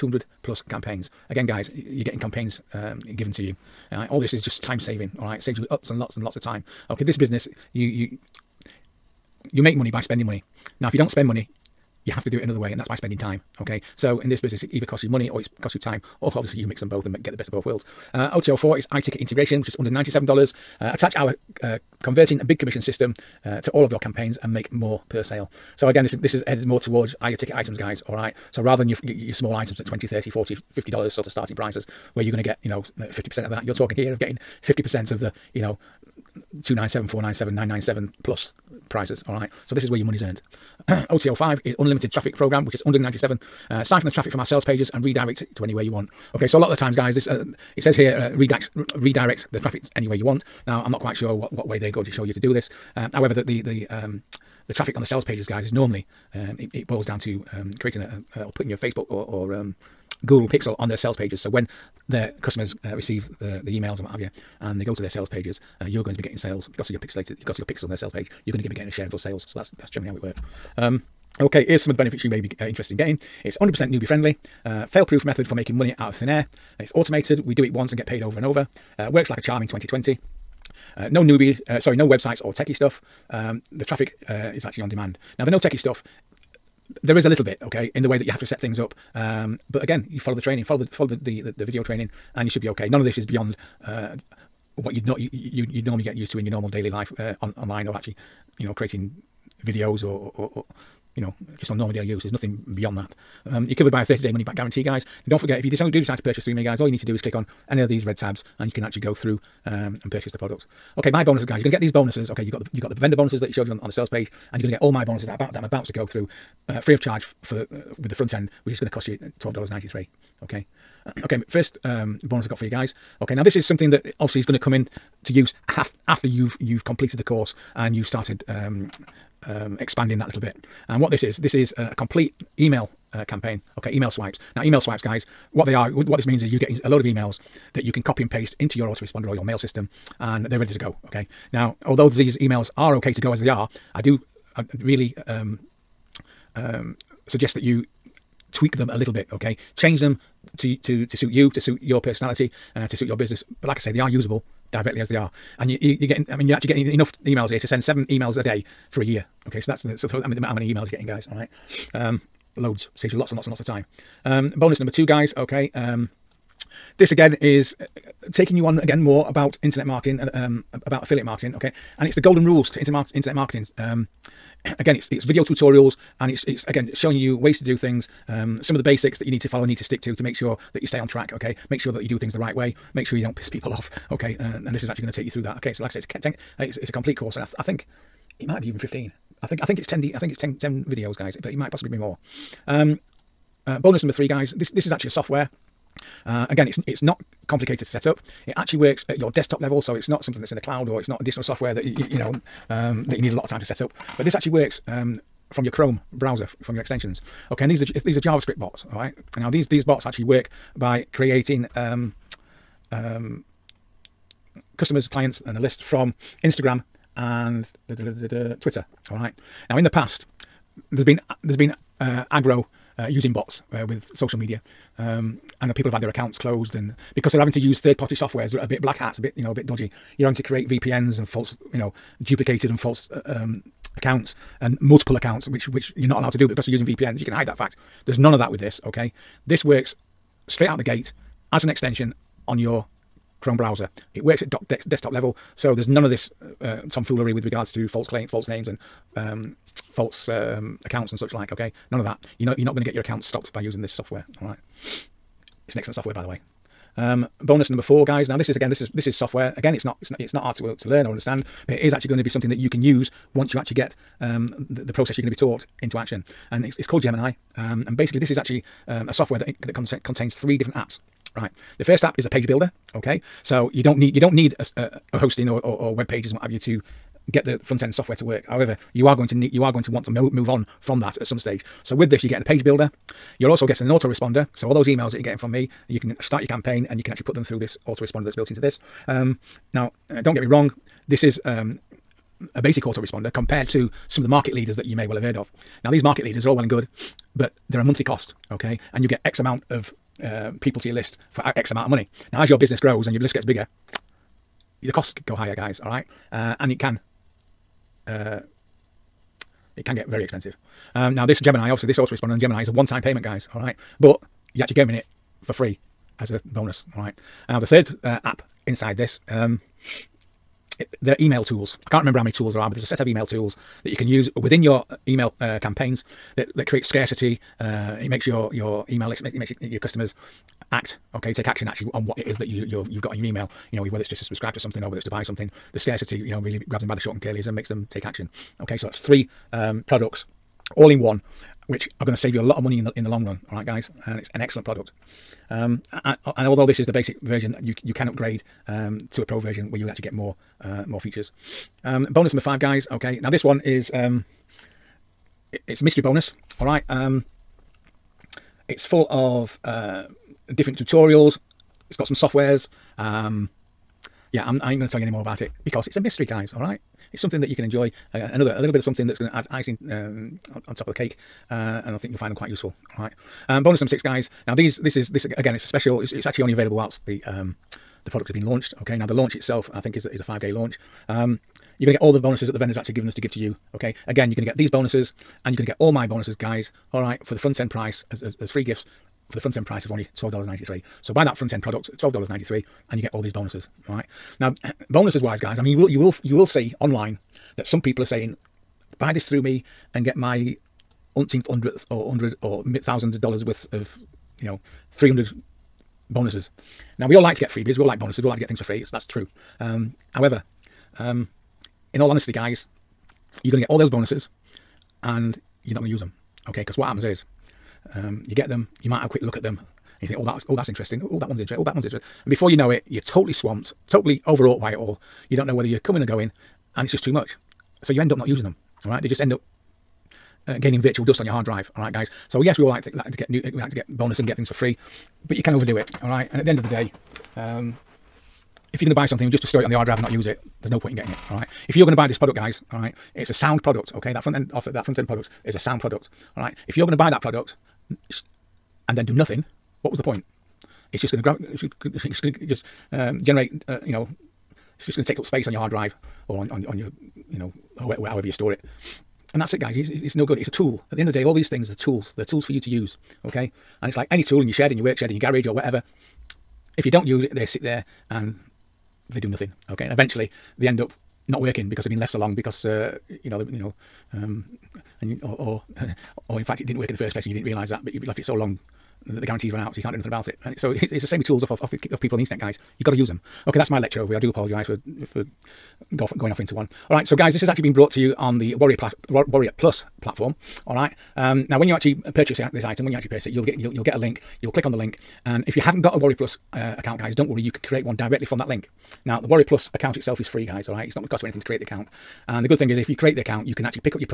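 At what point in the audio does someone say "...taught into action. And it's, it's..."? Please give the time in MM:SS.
04:25.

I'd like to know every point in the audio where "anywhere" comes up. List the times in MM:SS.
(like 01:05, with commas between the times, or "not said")
00:45, 00:49.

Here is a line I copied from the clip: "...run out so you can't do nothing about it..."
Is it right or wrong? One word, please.
right.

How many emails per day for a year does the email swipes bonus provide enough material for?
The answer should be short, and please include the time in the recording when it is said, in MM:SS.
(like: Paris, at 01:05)
7, at 02:37.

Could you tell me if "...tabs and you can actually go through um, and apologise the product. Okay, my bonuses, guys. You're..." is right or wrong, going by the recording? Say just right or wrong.
wrong.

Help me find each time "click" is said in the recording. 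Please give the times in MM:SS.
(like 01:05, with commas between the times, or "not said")
01:47, 08:14.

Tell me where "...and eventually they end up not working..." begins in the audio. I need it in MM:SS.
07:49.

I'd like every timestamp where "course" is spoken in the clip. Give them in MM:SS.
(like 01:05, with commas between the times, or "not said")
02:07, 03:07.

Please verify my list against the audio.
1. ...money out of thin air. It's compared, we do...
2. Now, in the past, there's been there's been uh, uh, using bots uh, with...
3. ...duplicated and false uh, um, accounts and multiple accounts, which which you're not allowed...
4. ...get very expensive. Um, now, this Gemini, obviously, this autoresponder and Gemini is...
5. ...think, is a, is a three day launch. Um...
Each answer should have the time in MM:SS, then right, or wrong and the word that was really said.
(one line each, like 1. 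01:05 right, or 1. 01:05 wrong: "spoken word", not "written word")
1. 01:15 wrong: "automated", not "compared"
2. 03:39 right
3. 03:52 right
4. 05:09 right
5. 06:19 wrong: "five", not "three".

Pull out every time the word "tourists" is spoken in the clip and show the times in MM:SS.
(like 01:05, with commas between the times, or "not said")
not said.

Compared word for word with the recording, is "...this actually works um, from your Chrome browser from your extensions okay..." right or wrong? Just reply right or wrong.
right.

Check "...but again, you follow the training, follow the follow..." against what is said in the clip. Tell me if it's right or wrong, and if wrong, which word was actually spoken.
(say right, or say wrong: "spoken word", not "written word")
right.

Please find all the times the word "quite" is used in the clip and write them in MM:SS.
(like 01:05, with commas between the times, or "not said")
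00:51, 06:12.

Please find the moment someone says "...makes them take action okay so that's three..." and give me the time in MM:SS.
05:37.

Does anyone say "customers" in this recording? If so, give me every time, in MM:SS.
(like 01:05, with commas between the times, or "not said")
01:02, 03:34, 05:29.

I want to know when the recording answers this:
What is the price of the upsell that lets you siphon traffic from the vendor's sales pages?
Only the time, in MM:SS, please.
00:42.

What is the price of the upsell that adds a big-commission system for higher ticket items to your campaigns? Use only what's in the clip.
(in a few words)
$97.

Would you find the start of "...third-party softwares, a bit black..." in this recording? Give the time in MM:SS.
03:47.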